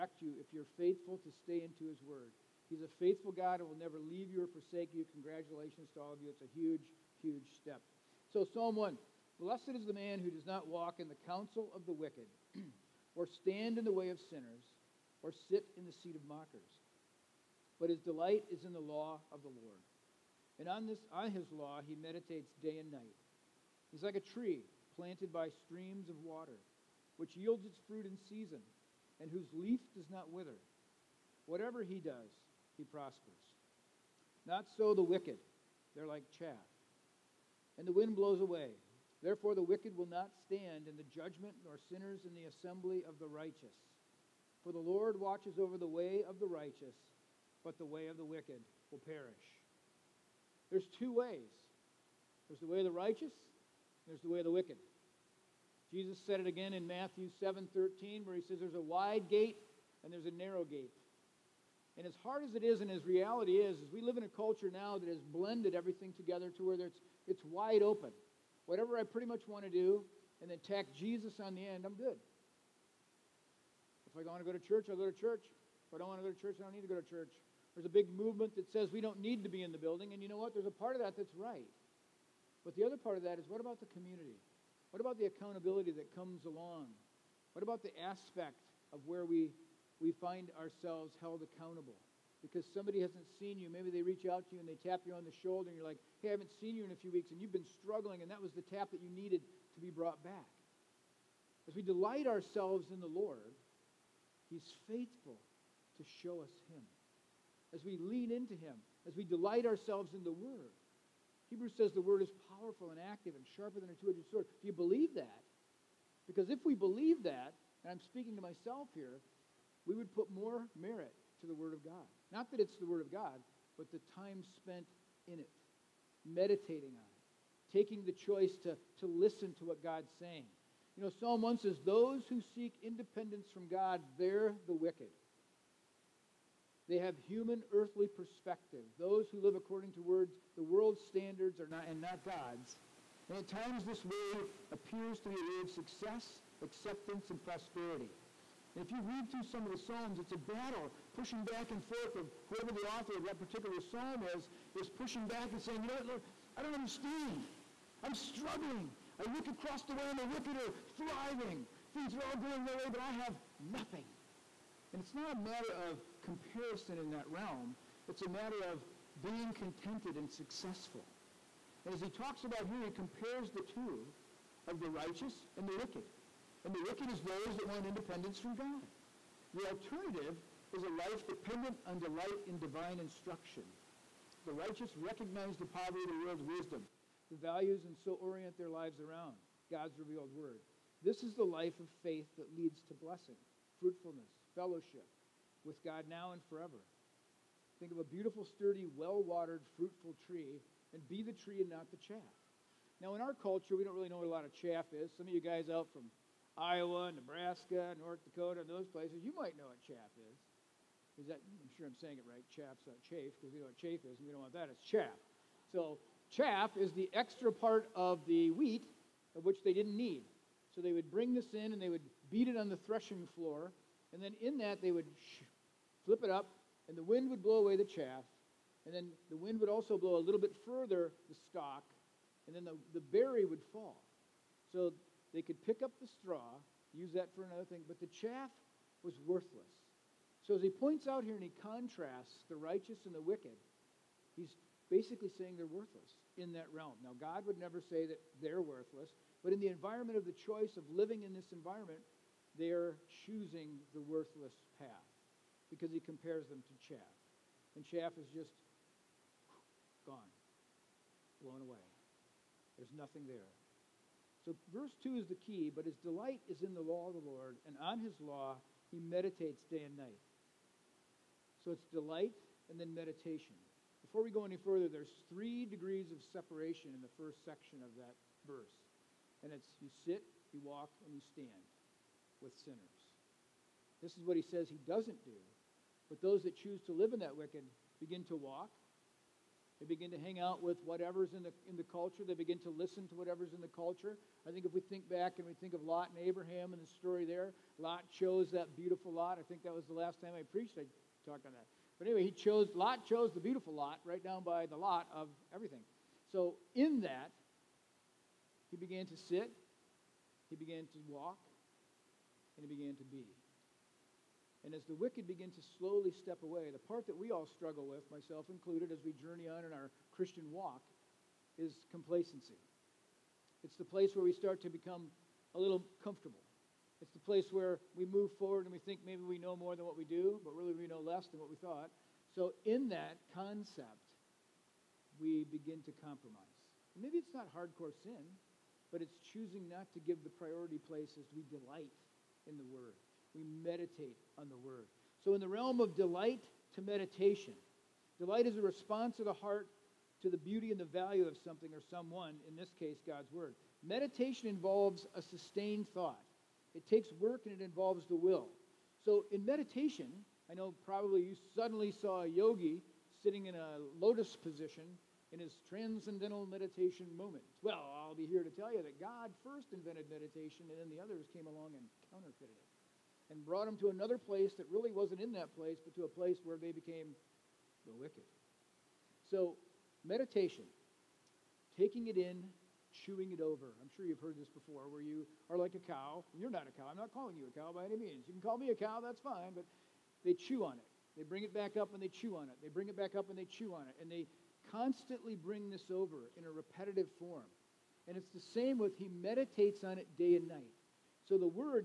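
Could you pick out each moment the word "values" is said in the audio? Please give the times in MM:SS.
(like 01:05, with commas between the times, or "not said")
03:07, 05:50.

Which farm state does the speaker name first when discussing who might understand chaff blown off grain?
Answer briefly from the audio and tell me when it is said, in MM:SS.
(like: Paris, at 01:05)
Iowa, at 03:26.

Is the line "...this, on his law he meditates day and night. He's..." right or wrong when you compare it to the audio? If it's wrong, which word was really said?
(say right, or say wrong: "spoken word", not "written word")
right.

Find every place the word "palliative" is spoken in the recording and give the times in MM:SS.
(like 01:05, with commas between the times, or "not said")
not said.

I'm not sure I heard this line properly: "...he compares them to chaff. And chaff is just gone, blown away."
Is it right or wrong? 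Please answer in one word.
right.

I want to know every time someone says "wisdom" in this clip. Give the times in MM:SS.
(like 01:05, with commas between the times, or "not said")
03:06.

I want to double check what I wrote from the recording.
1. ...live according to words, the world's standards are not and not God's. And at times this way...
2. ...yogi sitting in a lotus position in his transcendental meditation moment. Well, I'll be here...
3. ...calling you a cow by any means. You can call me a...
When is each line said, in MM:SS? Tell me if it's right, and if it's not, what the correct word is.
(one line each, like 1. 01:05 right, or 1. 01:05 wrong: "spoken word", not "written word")
1. 02:19 right
2. 06:02 right
3. 06:27 right.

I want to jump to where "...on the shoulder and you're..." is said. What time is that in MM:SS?
01:35.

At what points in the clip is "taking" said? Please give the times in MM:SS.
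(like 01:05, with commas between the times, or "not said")
02:07, 06:21.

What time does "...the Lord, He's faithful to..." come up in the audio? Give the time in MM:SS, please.
01:42.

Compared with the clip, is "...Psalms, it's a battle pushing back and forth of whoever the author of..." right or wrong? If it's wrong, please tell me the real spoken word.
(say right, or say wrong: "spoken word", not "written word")
right.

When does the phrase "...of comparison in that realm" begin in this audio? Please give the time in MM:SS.
02:45.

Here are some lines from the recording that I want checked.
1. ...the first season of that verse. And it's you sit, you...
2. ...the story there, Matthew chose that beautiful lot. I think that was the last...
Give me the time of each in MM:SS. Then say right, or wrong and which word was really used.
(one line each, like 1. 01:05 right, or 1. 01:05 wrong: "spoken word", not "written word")
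1. 04:37 wrong: "section", not "season"
2. 04:56 wrong: "Lot", not "Matthew".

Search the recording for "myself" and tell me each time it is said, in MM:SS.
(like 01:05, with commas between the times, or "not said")
01:58, 05:18.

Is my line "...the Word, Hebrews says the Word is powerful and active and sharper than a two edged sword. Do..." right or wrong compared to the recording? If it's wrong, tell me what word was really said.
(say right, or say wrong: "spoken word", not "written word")
right.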